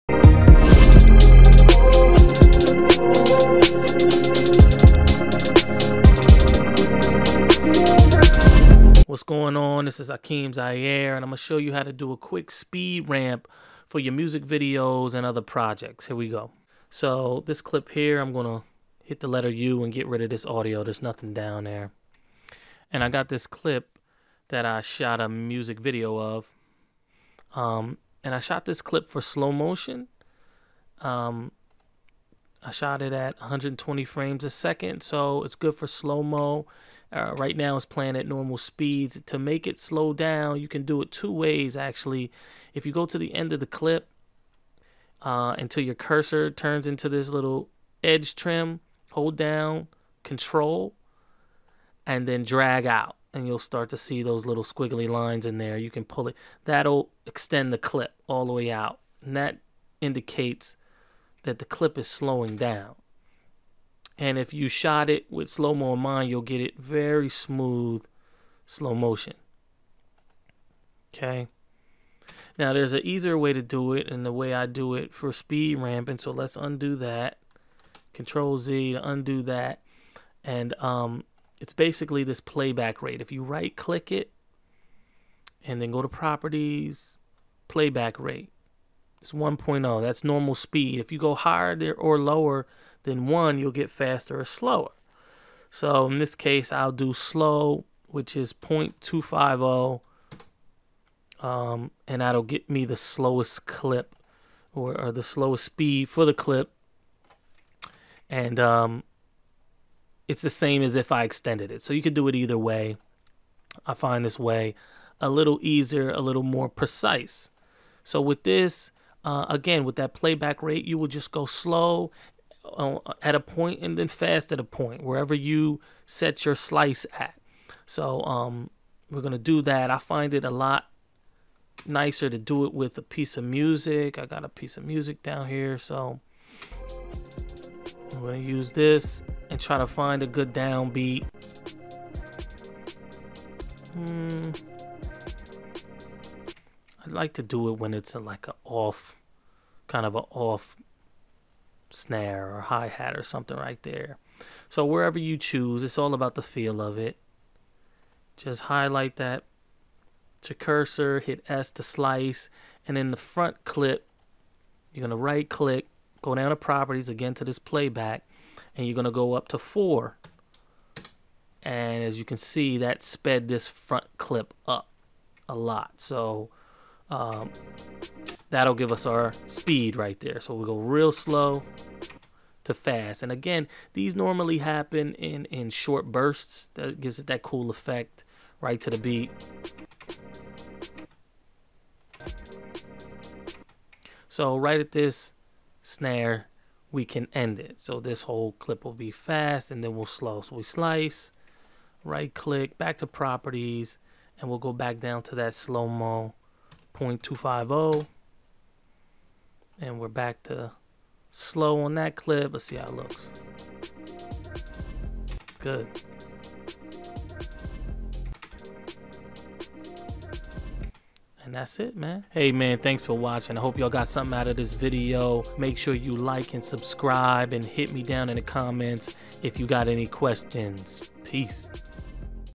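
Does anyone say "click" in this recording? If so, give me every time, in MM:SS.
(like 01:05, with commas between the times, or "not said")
01:23, 02:45, 03:22.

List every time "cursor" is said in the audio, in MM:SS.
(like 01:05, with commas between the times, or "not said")
00:45, 02:40.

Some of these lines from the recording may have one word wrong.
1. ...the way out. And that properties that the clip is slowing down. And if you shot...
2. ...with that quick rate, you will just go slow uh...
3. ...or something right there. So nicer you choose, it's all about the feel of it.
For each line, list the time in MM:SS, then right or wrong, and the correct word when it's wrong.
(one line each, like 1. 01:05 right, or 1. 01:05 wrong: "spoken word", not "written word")
1. 00:58 wrong: "indicates", not "properties"
2. 01:59 wrong: "playback", not "quick"
3. 02:33 wrong: "wherever", not "nicer".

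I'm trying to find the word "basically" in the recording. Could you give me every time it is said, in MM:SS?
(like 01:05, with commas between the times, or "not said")
01:21.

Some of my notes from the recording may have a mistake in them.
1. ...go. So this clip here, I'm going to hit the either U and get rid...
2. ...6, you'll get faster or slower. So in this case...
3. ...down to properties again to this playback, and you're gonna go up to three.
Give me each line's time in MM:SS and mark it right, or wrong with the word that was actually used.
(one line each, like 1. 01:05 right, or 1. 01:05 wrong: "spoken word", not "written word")
1. 00:16 wrong: "letter", not "either"
2. 01:33 wrong: "1", not "6"
3. 02:46 wrong: "four", not "three".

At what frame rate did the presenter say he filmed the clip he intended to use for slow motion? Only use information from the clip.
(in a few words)
120 frames a second.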